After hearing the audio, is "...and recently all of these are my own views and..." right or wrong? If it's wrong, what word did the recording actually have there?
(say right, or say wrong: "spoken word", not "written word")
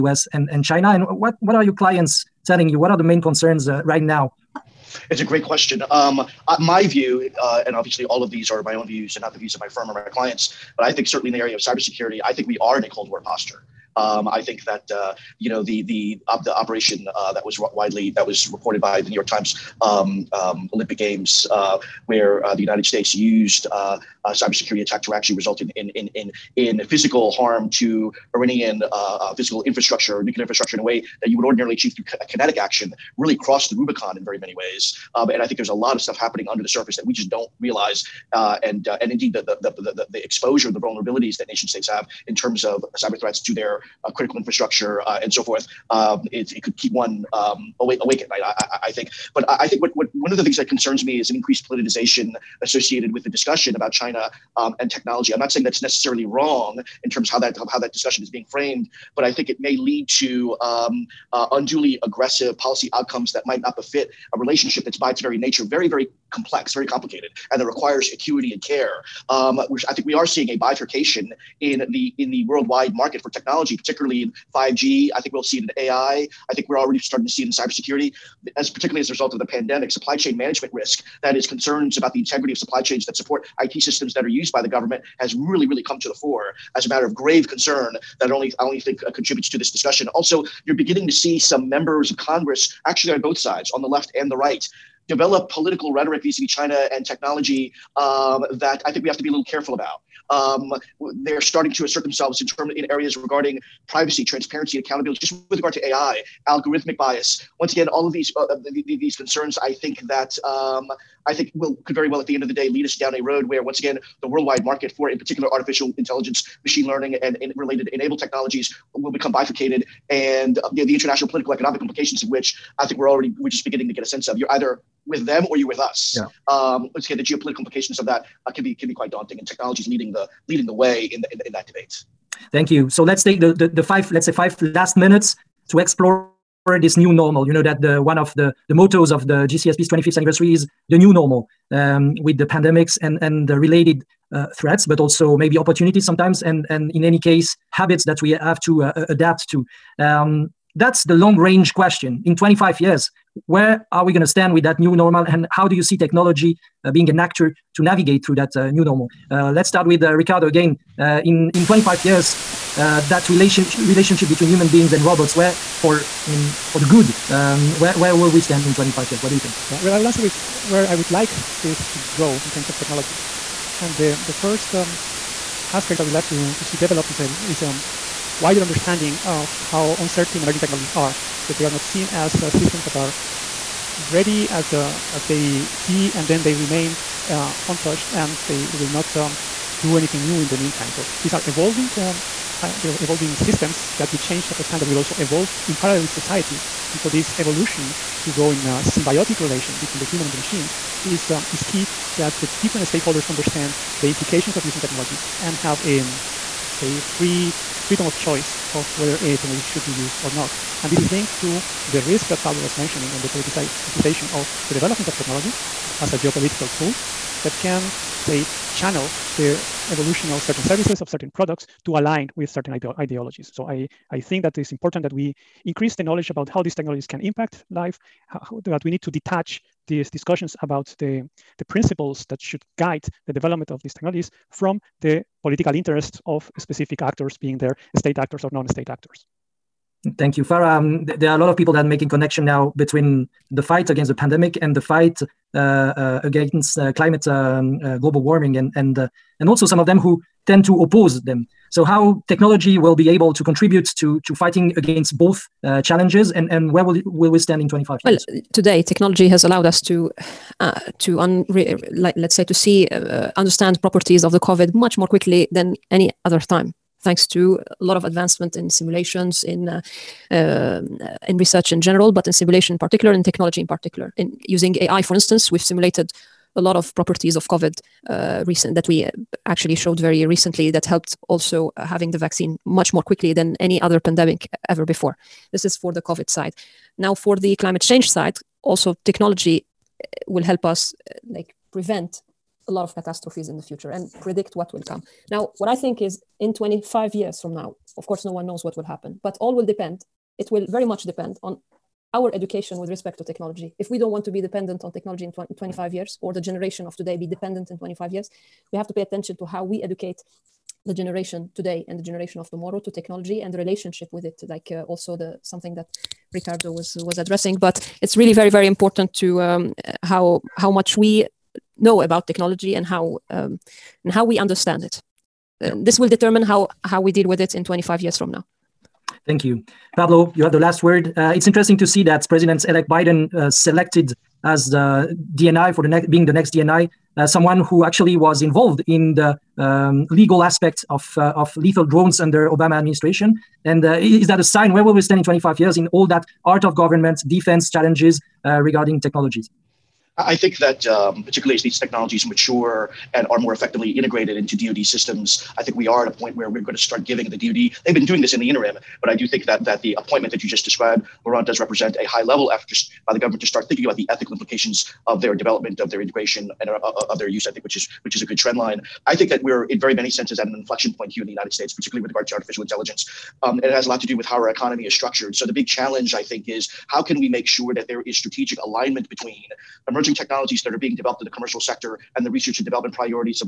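wrong: "obviously", not "recently".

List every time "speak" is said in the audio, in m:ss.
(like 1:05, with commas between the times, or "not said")
not said.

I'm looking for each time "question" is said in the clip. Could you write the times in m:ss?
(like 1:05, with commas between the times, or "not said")
0:05, 2:31.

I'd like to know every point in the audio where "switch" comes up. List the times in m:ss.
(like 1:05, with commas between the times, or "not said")
not said.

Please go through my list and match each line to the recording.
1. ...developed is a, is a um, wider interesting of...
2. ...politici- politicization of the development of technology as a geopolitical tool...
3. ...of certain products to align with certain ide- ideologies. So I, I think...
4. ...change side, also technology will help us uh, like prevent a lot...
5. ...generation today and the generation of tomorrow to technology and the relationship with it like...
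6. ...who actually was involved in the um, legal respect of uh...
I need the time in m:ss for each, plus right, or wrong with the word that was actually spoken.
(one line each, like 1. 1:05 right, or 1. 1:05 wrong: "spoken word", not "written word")
1. 2:56 wrong: "understanding", not "interesting"
2. 3:33 right
3. 3:41 right
4. 4:47 right
5. 5:10 right
6. 5:37 wrong: "aspect", not "respect".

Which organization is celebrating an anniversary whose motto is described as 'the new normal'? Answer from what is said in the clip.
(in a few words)
GCSP.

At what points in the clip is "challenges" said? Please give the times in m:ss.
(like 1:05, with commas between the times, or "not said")
4:15, 5:47, 6:15.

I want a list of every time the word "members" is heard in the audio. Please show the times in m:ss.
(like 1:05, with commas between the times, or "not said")
1:31.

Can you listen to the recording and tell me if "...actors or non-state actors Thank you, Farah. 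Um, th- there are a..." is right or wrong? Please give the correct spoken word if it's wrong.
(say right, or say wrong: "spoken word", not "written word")
right.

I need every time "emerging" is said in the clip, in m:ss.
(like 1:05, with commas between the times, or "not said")
3:00, 6:19.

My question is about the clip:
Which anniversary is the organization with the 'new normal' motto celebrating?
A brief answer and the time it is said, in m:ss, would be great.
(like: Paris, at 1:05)
25th, at 2:19.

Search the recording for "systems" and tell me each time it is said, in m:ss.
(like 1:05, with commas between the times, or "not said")
1:23, 3:02, 3:13, 5:54.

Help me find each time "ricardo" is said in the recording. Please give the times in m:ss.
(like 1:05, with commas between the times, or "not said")
2:40, 5:16.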